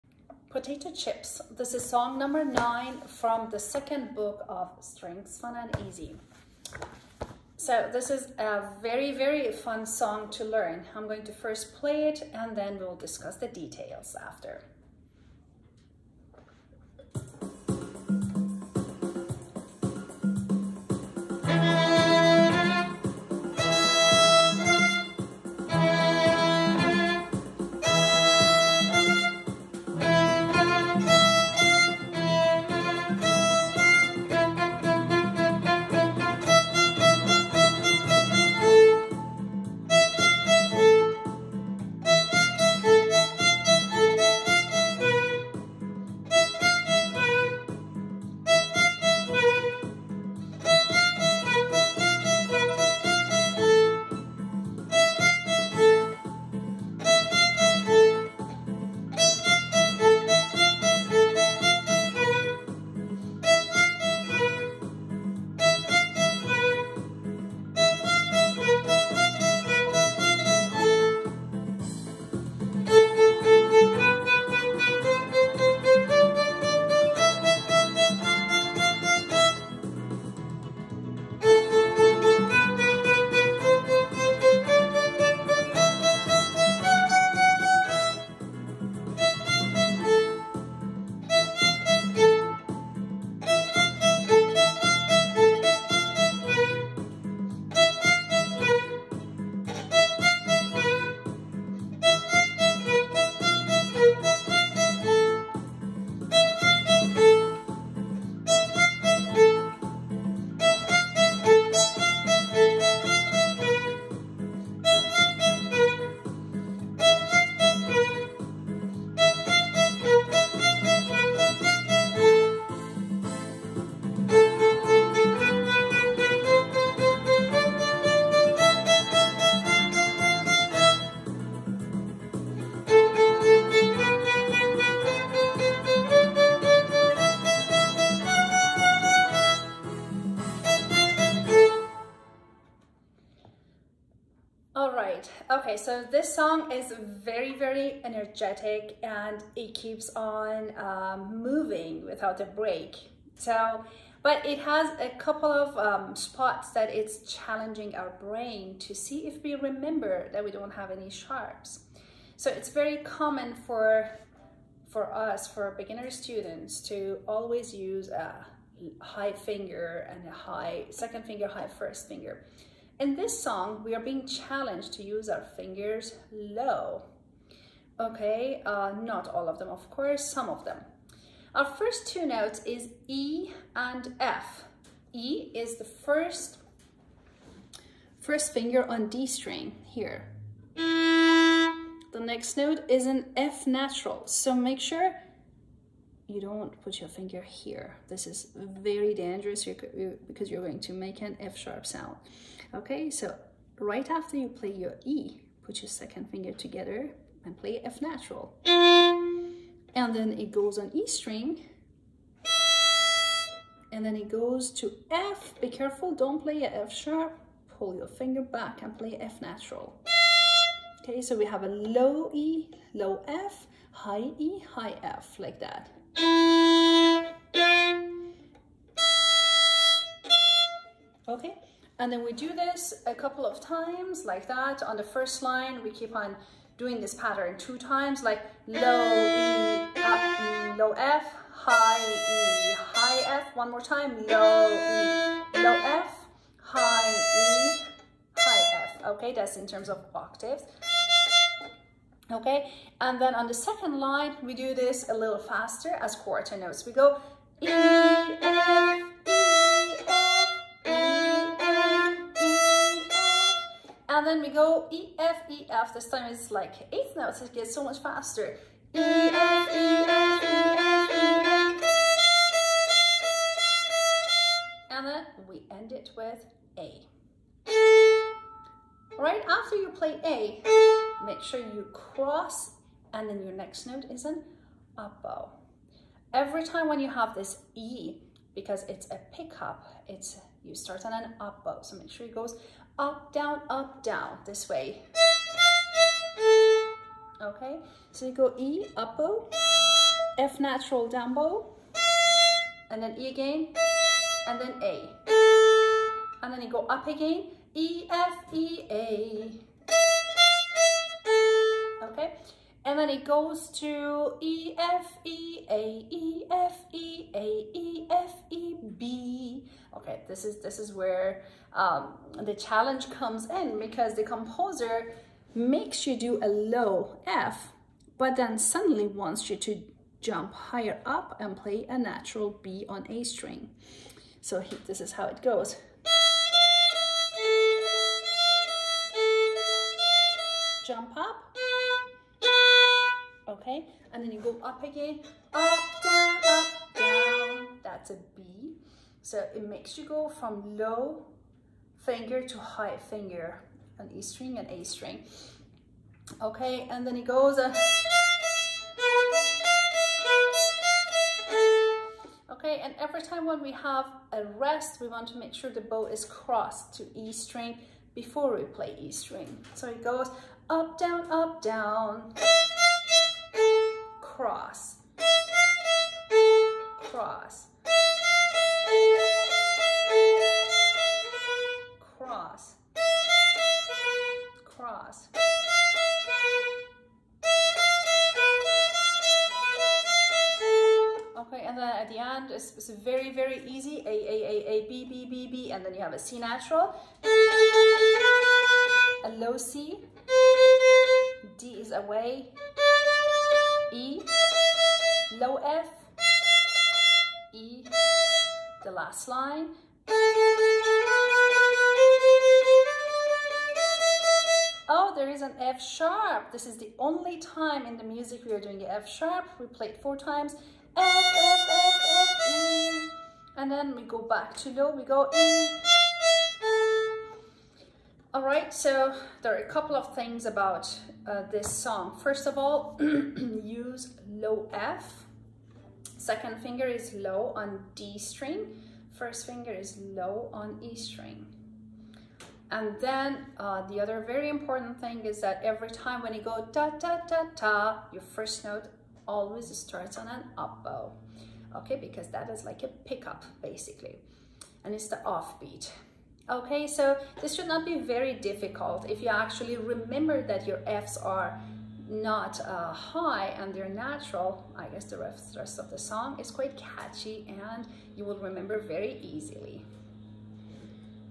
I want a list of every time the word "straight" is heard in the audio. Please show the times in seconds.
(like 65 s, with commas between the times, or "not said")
not said.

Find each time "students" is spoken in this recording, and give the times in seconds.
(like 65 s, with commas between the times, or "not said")
166 s.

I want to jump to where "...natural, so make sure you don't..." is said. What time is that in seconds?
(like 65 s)
193 s.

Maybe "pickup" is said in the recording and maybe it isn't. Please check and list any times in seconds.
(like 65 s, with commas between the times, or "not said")
289 s, 452 s.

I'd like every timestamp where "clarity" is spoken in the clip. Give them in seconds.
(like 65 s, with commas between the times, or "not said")
not said.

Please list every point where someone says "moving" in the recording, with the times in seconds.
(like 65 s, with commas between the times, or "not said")
151 s.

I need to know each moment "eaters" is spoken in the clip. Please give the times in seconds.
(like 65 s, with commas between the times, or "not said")
not said.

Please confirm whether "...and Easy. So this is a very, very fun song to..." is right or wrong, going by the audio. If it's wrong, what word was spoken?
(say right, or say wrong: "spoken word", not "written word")
right.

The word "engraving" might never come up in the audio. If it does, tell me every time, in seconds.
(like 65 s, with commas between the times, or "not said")
not said.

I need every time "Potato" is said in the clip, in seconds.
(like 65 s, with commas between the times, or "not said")
0 s.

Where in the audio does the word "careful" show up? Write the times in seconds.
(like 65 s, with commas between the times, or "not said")
215 s.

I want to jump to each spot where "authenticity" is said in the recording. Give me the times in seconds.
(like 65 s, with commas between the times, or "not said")
not said.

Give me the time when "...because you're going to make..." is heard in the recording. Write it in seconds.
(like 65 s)
199 s.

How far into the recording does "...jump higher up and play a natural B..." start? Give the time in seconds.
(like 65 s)
330 s.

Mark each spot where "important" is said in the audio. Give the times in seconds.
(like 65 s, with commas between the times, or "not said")
444 s.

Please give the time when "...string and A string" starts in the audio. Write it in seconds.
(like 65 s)
354 s.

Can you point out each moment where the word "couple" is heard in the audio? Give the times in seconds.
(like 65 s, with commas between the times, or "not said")
155 s, 233 s, 429 s.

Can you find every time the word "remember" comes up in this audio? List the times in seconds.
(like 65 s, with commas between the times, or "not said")
159 s, 459 s, 468 s.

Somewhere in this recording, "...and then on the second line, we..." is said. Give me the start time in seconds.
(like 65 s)
252 s.